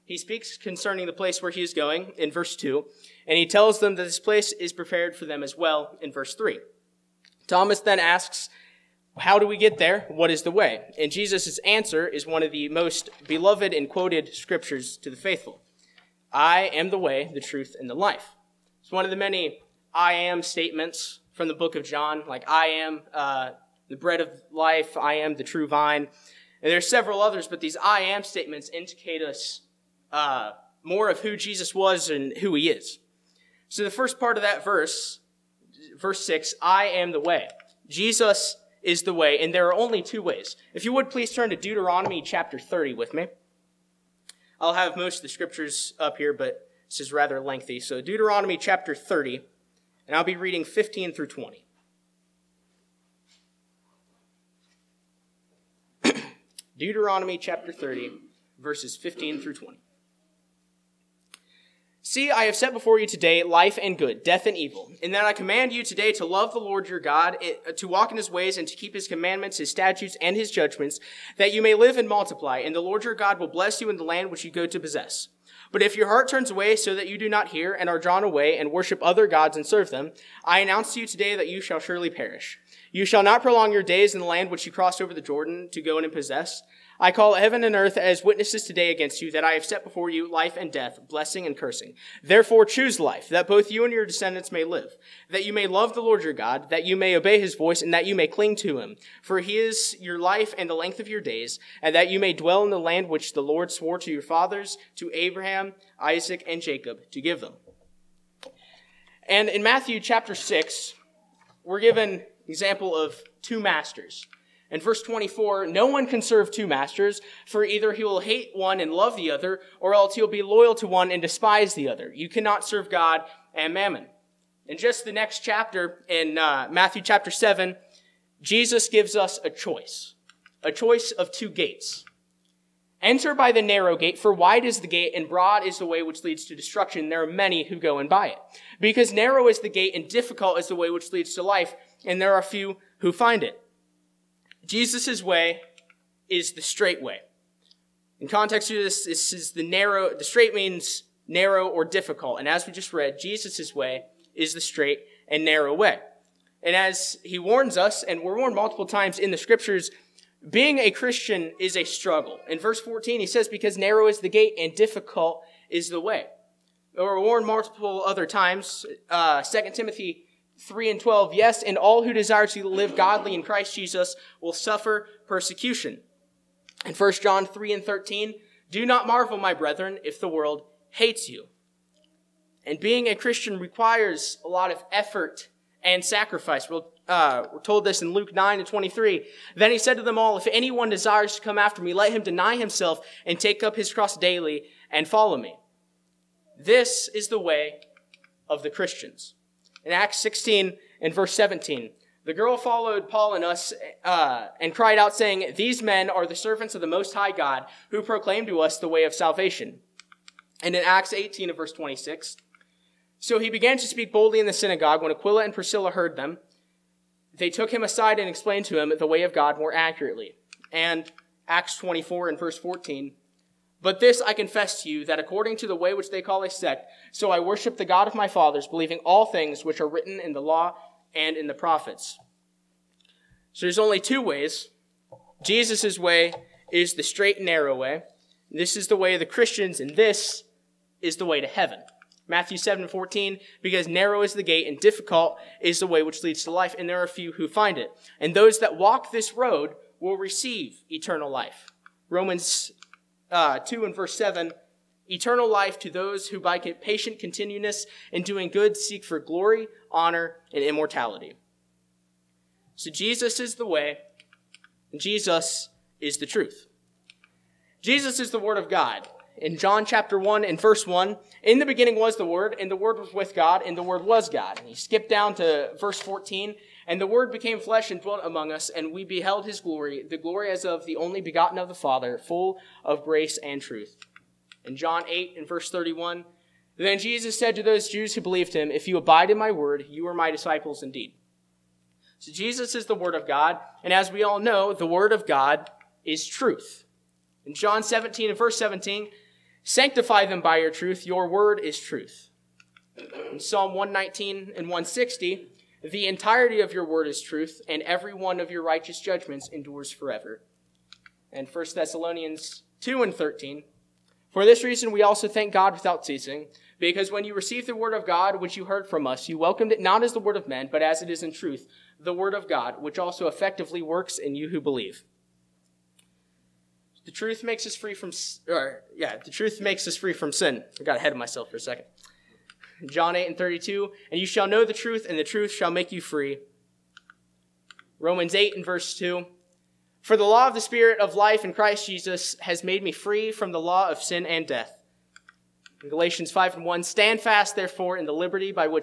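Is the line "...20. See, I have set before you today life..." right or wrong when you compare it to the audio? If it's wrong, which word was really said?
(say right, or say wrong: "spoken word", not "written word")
right.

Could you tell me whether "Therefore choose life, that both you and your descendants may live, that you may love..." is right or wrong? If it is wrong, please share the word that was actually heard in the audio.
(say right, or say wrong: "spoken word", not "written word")
right.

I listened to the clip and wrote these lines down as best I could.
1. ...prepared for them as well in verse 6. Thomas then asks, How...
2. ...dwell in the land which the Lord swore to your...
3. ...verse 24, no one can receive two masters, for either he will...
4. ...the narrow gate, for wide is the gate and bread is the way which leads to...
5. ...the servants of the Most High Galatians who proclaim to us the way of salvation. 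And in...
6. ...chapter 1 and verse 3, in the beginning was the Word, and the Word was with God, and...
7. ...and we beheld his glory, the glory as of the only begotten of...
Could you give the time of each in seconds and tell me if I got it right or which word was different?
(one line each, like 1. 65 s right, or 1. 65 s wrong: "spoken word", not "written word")
1. 4 s wrong: "3", not "6"
2. 102 s right
3. 114 s wrong: "serve", not "receive"
4. 133 s wrong: "broad", not "bread"
5. 206 s wrong: "God", not "Galatians"
6. 269 s wrong: "1", not "3"
7. 278 s right.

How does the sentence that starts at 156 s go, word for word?
And as he warns us, and we're warned multiple times in the scriptures, being a Christian is a struggle.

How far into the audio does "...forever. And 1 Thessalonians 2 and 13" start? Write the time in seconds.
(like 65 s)
309 s.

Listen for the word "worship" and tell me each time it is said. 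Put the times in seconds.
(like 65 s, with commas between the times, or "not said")
78 s, 227 s.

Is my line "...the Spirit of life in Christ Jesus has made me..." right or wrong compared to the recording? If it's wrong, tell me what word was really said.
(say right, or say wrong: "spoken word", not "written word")
right.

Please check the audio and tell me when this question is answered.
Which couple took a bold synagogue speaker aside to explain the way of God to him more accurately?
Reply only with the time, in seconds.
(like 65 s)
215 s.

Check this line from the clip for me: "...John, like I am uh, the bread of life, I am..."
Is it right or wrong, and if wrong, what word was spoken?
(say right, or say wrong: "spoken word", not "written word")
right.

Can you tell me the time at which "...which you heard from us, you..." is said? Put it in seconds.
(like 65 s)
318 s.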